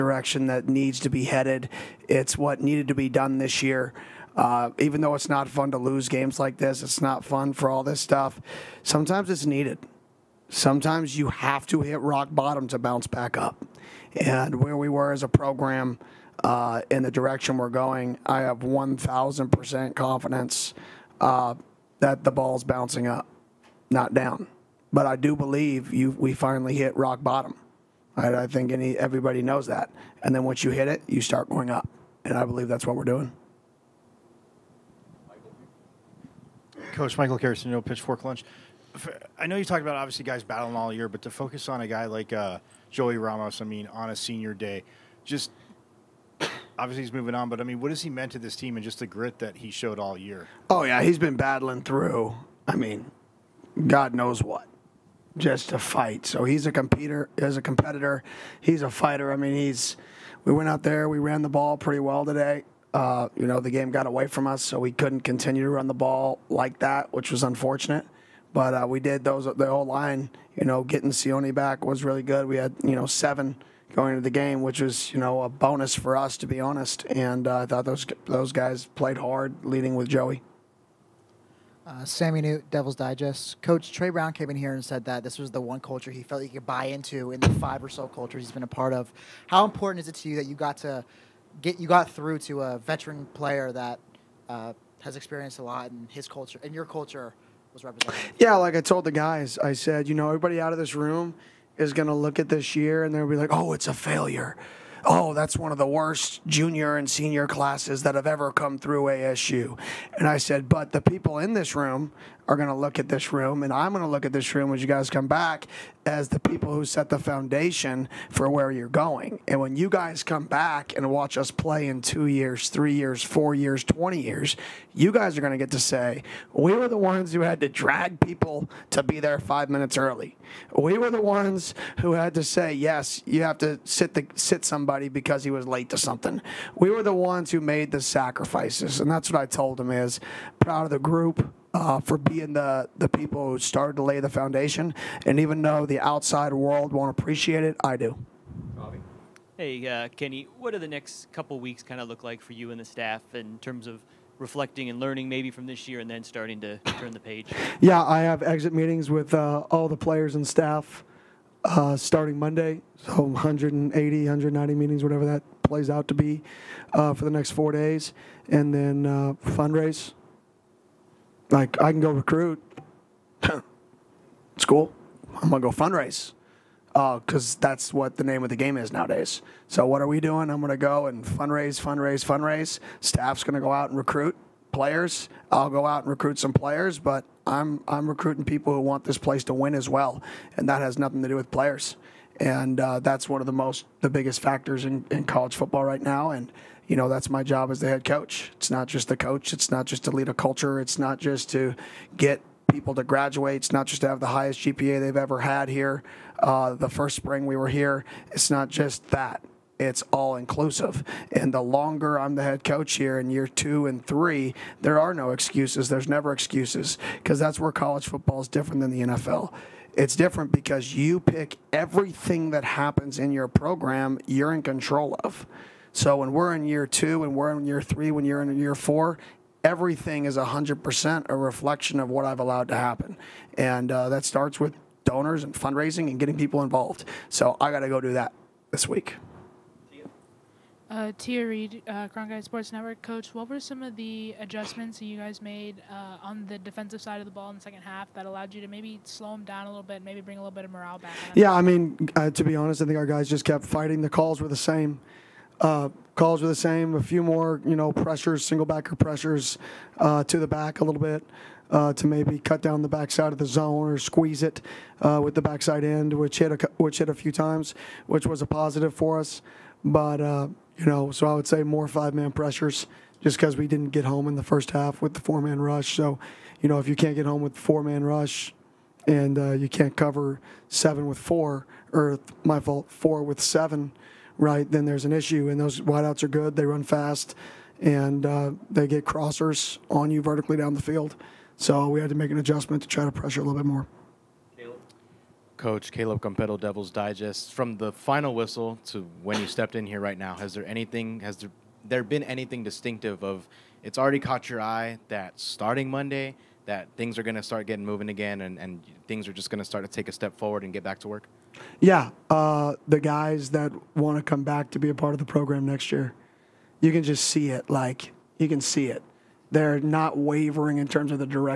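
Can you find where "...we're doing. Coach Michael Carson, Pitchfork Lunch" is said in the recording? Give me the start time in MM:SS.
00:32.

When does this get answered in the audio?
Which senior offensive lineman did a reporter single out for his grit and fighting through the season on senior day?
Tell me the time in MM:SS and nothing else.
00:42.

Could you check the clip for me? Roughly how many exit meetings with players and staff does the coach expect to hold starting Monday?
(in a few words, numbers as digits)
180 to 190.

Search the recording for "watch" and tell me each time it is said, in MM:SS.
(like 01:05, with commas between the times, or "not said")
02:01.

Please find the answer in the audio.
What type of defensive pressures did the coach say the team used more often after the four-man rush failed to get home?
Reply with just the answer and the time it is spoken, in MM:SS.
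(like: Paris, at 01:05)
Five man pressures, at 04:31.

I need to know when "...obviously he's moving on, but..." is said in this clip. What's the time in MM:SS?
00:46.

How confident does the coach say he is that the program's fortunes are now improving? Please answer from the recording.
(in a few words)
1,000%.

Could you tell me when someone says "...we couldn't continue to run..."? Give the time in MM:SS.
01:04.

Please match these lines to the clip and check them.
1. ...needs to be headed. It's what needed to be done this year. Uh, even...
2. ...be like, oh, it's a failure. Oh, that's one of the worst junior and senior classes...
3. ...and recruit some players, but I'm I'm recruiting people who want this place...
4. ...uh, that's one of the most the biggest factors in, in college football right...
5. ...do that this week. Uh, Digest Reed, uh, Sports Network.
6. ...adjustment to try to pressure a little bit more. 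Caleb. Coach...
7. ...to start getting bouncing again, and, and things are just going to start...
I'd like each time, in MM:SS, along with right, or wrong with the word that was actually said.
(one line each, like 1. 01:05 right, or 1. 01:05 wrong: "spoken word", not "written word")
1. 00:00 right
2. 01:43 right
3. 03:06 right
4. 03:12 right
5. 03:58 wrong: "Tia", not "Digest"
6. 04:52 right
7. 05:07 wrong: "moving", not "bouncing".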